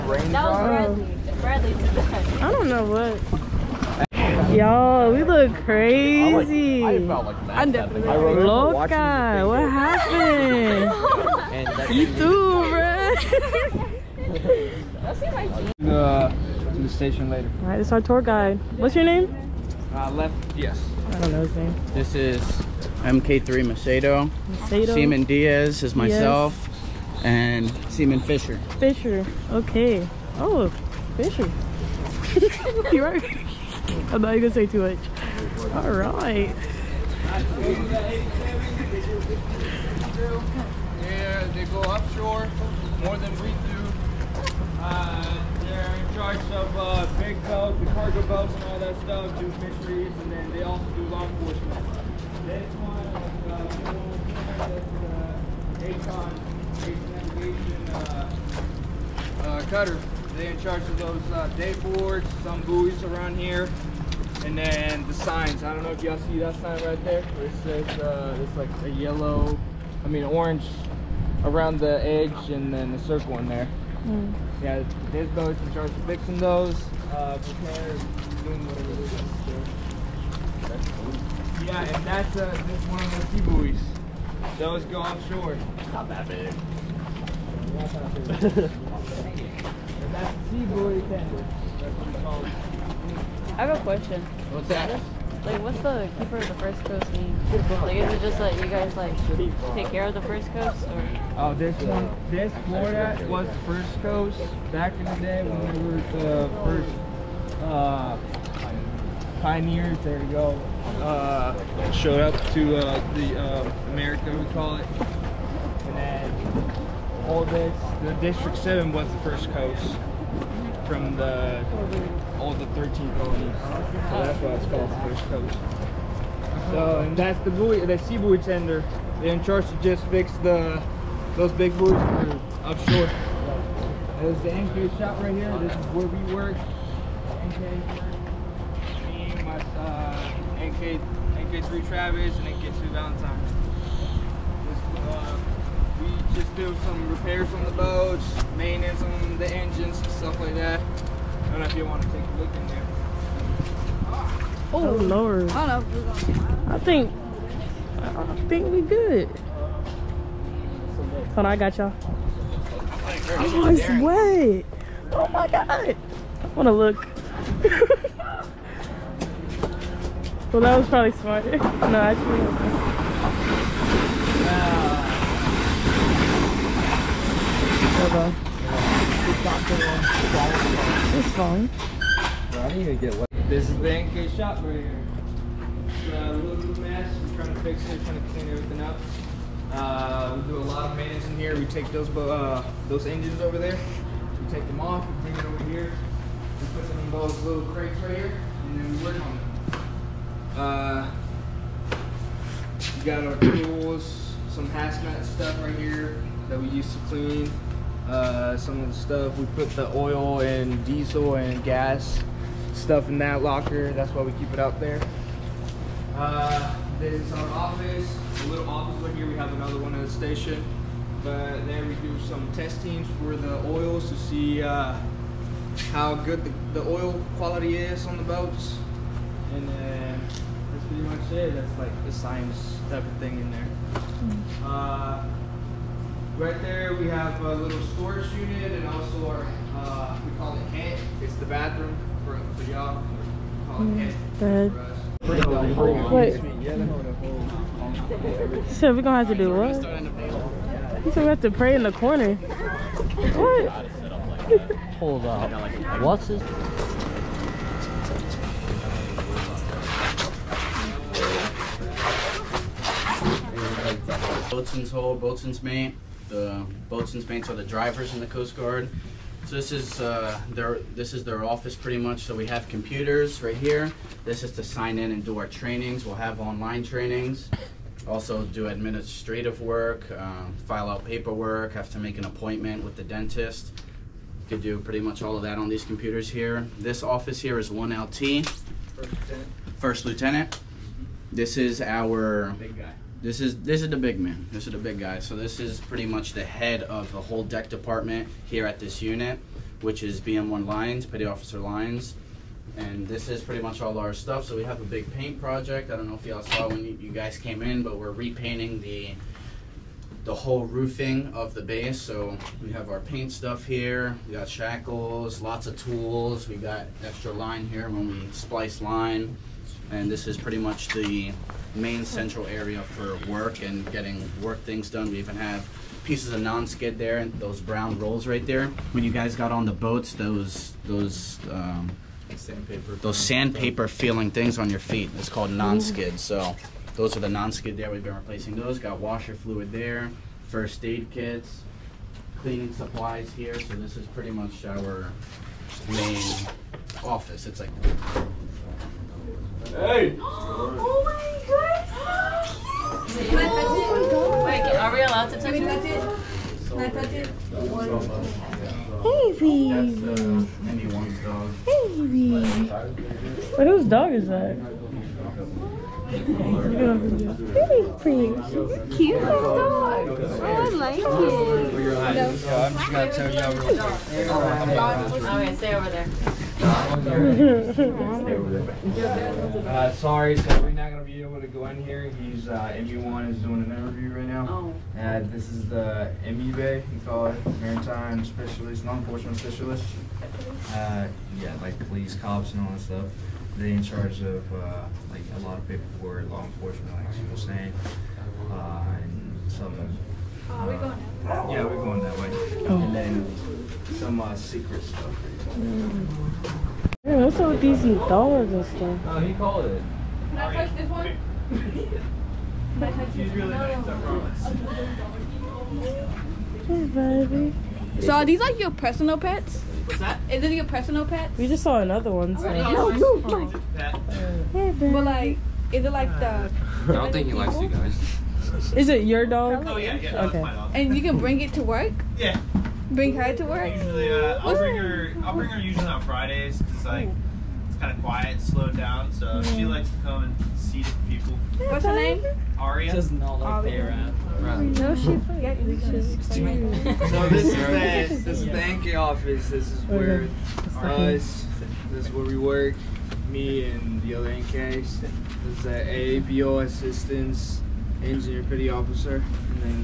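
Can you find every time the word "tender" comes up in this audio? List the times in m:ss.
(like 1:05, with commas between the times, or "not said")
1:31, 2:08.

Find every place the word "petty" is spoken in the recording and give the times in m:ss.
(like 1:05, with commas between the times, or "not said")
5:01, 7:38.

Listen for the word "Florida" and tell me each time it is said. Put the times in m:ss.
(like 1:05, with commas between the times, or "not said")
1:42.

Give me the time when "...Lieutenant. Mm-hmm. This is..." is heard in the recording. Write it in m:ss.
4:50.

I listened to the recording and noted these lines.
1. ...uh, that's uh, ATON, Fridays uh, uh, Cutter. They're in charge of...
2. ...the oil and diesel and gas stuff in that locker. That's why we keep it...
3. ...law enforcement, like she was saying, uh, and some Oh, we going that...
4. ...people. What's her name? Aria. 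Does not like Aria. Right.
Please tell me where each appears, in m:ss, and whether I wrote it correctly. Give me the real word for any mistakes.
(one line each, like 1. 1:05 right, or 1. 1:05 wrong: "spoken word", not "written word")
1. 0:53 wrong: "Navigation", not "Fridays"
2. 3:29 right
3. 6:36 right
4. 7:21 right.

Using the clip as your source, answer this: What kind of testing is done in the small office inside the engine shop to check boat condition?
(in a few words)
oil quality.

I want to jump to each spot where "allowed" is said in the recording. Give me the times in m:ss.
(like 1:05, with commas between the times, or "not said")
5:55.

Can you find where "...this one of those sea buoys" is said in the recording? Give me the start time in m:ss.
1:22.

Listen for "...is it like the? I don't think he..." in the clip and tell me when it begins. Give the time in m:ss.
7:05.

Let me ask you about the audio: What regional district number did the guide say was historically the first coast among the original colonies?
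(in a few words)
District Seven.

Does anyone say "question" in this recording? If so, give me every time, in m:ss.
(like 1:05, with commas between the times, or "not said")
1:33.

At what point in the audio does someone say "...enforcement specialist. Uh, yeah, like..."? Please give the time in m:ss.
6:28.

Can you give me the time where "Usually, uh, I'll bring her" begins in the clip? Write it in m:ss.
7:13.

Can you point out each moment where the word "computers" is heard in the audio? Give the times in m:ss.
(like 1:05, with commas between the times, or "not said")
4:32, 4:45.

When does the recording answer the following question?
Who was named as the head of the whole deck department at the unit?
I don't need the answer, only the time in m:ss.
5:00.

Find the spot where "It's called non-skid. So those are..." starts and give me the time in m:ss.
5:35.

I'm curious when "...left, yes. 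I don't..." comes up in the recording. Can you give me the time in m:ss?
0:20.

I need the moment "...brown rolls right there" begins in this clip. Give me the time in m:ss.
5:27.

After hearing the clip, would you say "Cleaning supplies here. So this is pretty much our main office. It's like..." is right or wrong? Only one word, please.
right.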